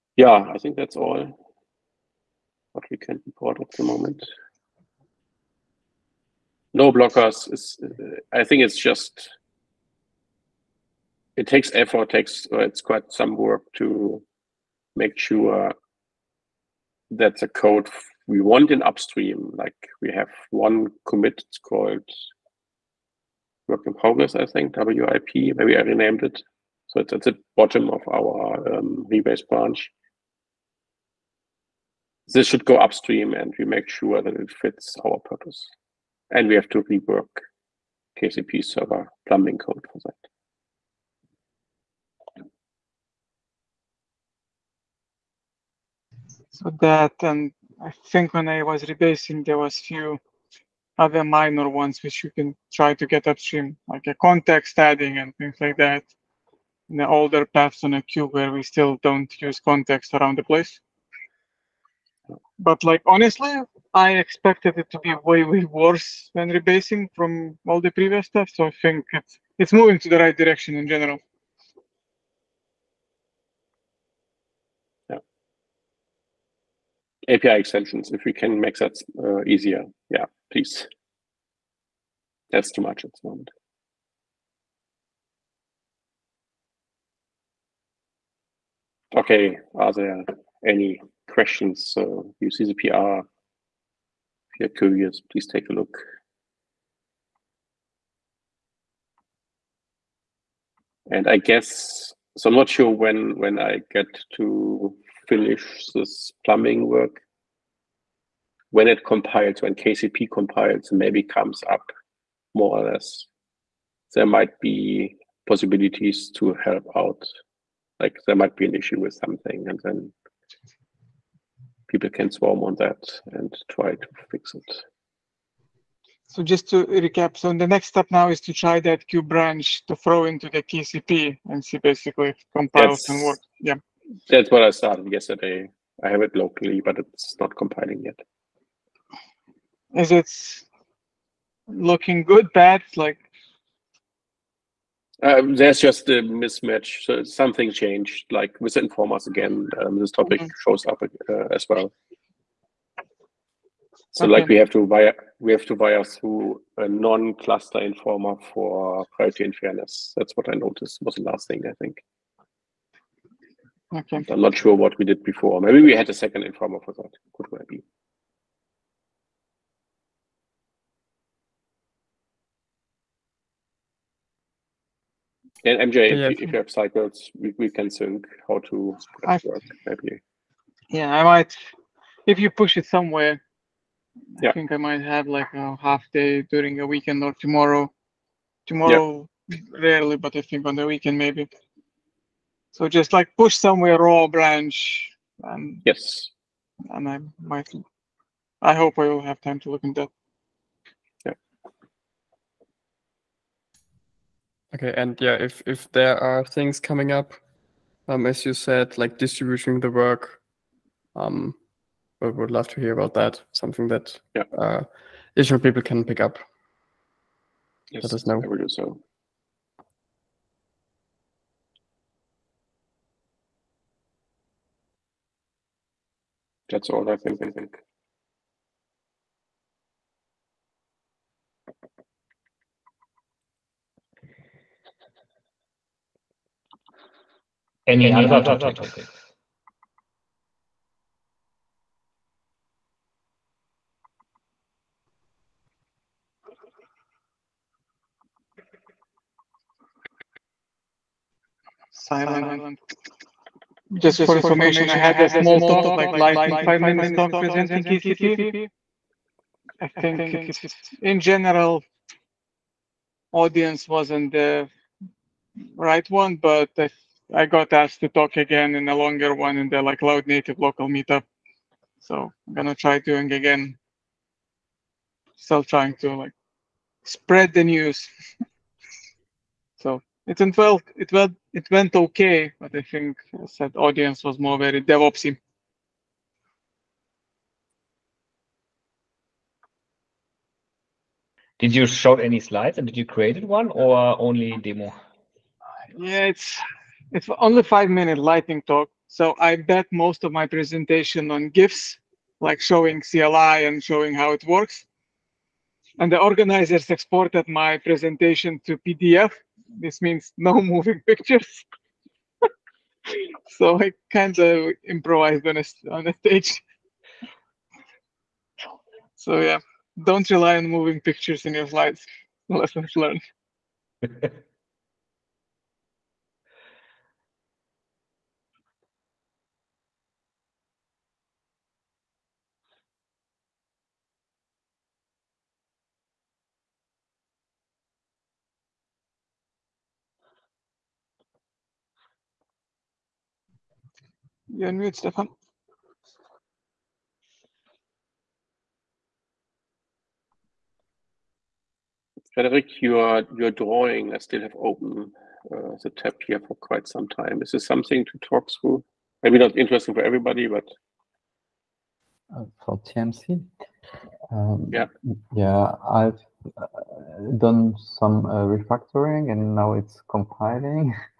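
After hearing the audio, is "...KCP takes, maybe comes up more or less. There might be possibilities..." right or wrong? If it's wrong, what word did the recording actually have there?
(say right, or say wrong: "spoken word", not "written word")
wrong: "compiles", not "takes".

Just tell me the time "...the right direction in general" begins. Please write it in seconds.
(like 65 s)
70 s.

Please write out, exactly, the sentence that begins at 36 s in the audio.
And we have to rework KCP server plumbing code for that.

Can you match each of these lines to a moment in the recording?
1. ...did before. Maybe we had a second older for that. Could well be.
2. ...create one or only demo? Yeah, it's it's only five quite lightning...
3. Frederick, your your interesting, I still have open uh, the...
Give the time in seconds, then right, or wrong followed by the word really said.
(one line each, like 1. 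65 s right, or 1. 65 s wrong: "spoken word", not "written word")
1. 165 s wrong: "informer", not "older"
2. 293 s wrong: "minute", not "quite"
3. 352 s wrong: "drawing", not "interesting".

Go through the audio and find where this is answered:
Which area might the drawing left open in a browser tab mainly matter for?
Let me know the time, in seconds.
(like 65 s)
362 s.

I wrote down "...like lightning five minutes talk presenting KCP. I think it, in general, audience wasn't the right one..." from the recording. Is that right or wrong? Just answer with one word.
right.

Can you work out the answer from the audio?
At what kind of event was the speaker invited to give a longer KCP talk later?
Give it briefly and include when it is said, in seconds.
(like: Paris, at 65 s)
cloud native local meetup, at 269 s.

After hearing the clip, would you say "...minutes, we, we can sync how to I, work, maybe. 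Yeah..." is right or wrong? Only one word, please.
wrong.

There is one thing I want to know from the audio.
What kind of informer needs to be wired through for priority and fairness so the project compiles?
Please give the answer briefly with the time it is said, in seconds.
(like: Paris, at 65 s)
non-cluster informer, at 156 s.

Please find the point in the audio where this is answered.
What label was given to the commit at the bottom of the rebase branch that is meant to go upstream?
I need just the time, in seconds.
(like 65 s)
23 s.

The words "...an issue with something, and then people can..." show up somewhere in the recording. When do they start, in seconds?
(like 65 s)
118 s.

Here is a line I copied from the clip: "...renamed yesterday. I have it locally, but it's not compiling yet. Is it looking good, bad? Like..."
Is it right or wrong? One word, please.
wrong.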